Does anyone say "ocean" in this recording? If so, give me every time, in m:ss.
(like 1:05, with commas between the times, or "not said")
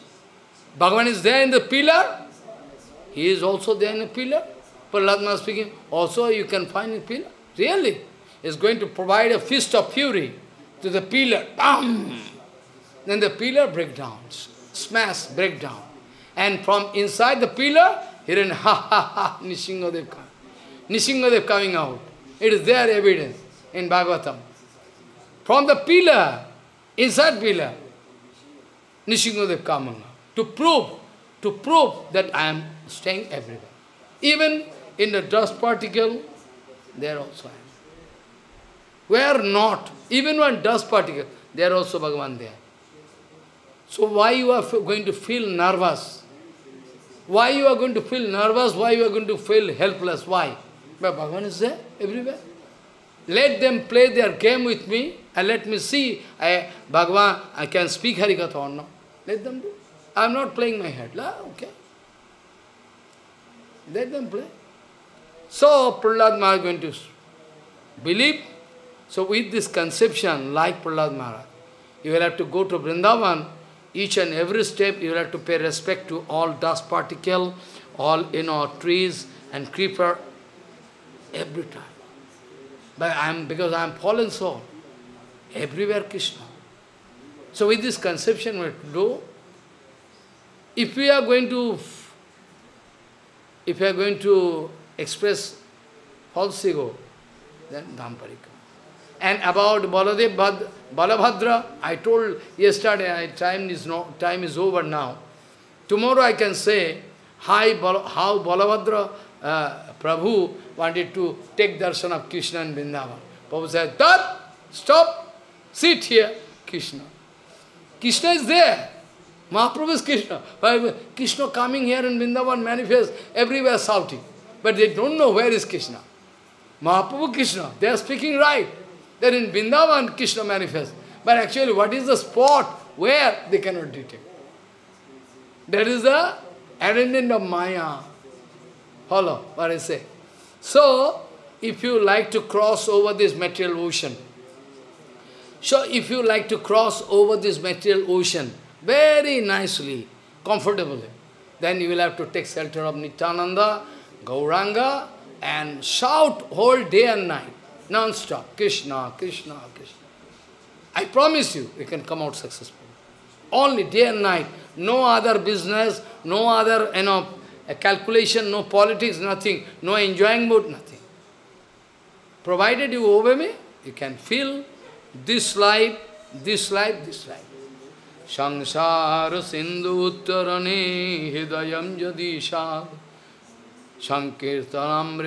2:23, 2:28.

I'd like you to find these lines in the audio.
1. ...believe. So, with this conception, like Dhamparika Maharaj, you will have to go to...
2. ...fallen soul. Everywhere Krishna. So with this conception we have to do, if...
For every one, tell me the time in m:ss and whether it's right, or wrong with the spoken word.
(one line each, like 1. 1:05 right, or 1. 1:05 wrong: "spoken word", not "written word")
1. 1:08 wrong: "Prahlad", not "Dhamparika"
2. 1:23 right.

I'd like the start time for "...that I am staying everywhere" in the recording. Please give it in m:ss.
0:32.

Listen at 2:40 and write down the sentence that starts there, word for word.
I promise you, you can come out successful.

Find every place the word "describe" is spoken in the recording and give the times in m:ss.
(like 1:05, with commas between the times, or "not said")
not said.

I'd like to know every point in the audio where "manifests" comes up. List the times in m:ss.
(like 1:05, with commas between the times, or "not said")
2:02, 2:10.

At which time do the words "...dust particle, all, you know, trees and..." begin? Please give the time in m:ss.
1:16.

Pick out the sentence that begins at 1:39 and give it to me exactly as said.
And about Baladev Bhad, Balabhadra, I told yesterday, time is, no, time is over now.